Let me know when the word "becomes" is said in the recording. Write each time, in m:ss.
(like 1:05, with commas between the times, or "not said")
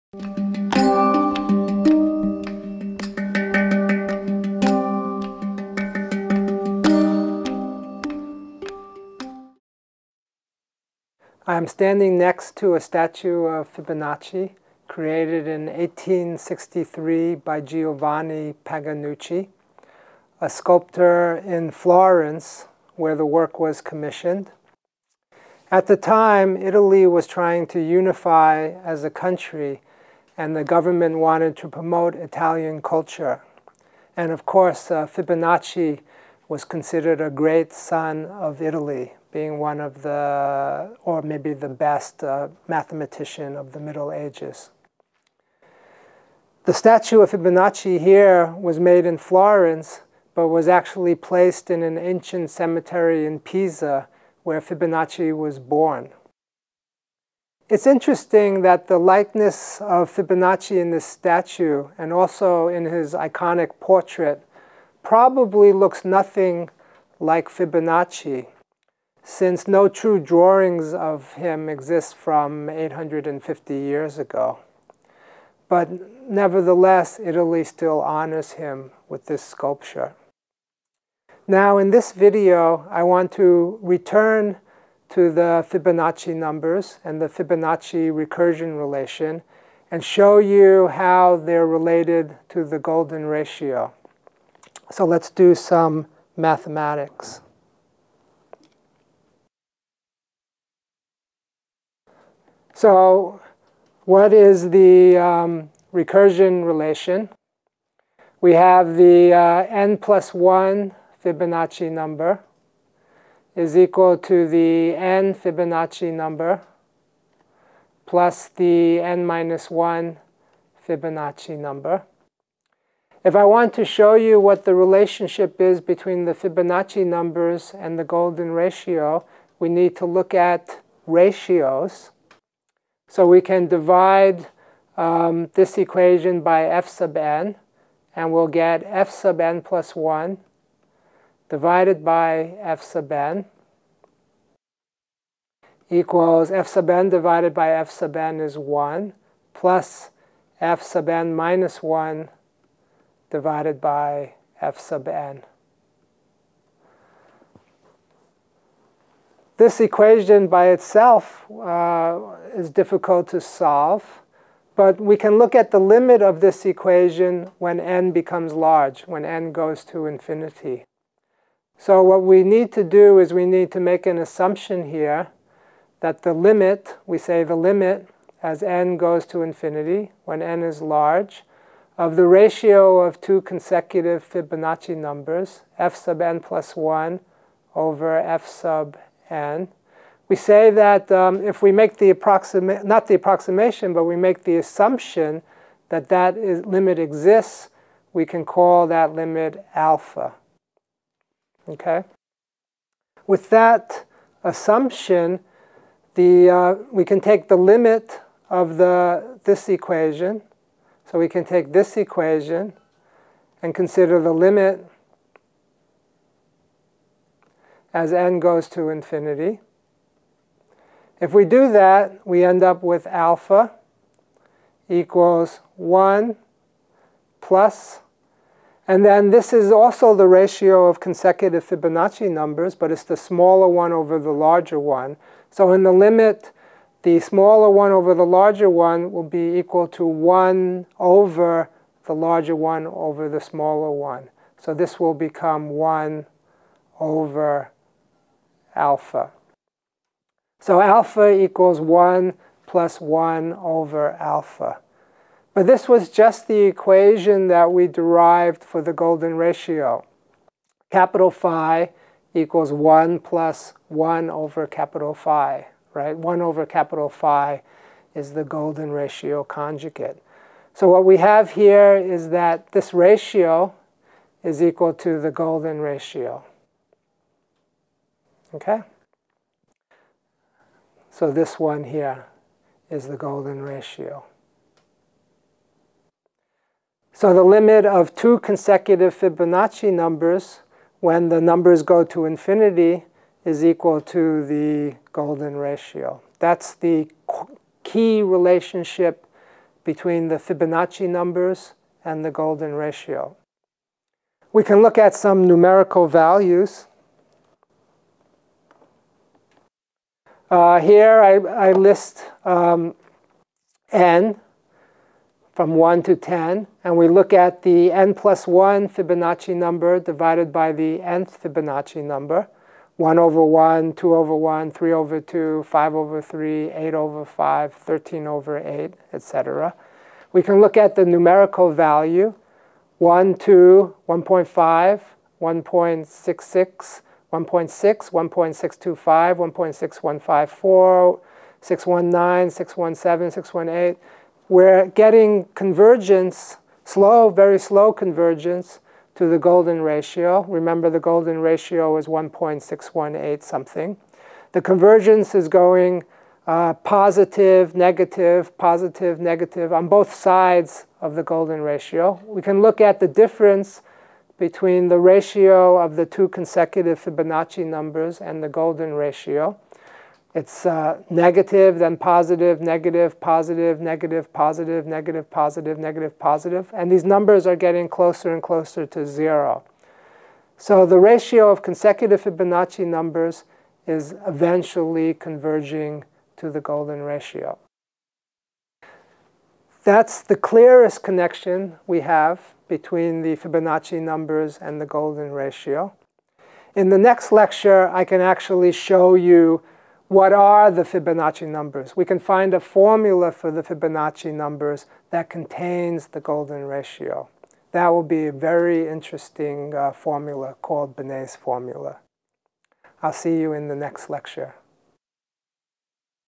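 2:48, 4:05.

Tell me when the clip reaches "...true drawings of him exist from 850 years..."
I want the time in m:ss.
1:09.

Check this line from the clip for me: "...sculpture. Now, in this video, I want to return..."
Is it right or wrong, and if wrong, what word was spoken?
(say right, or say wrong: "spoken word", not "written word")
right.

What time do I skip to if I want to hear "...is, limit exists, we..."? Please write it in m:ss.
3:16.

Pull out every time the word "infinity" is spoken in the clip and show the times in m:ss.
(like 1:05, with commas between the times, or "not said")
2:50, 2:59, 3:38, 4:52.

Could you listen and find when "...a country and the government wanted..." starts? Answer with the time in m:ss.
0:29.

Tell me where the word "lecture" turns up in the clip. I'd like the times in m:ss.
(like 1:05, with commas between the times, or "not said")
6:37, 6:54.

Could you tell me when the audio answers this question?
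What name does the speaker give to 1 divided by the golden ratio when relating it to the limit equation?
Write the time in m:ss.
4:28.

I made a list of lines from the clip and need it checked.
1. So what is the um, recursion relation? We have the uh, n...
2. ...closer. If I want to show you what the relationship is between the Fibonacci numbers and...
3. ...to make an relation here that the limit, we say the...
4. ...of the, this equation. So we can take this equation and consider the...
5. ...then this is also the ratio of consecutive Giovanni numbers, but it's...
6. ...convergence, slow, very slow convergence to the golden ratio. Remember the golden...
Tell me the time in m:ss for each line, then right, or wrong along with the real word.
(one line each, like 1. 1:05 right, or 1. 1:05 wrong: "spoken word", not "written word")
1. 1:42 right
2. 2:01 wrong: "number", not "closer"
3. 2:53 wrong: "assumption", not "relation"
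4. 3:28 right
5. 3:49 wrong: "Fibonacci", not "Giovanni"
6. 5:45 right.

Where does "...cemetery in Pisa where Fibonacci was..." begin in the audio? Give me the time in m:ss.
0:52.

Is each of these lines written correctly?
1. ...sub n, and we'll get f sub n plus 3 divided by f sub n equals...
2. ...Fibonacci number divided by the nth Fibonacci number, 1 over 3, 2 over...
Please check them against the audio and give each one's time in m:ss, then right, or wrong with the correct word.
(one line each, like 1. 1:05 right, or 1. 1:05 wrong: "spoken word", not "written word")
1. 2:16 wrong: "1", not "3"
2. 5:18 wrong: "1", not "3".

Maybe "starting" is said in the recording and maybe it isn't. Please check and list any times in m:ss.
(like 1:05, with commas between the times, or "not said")
not said.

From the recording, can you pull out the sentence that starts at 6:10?
It's uh, negative, then positive, negative, positive, negative, positive, negative, positive, negative, positive.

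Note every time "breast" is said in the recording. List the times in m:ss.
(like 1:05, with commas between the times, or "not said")
not said.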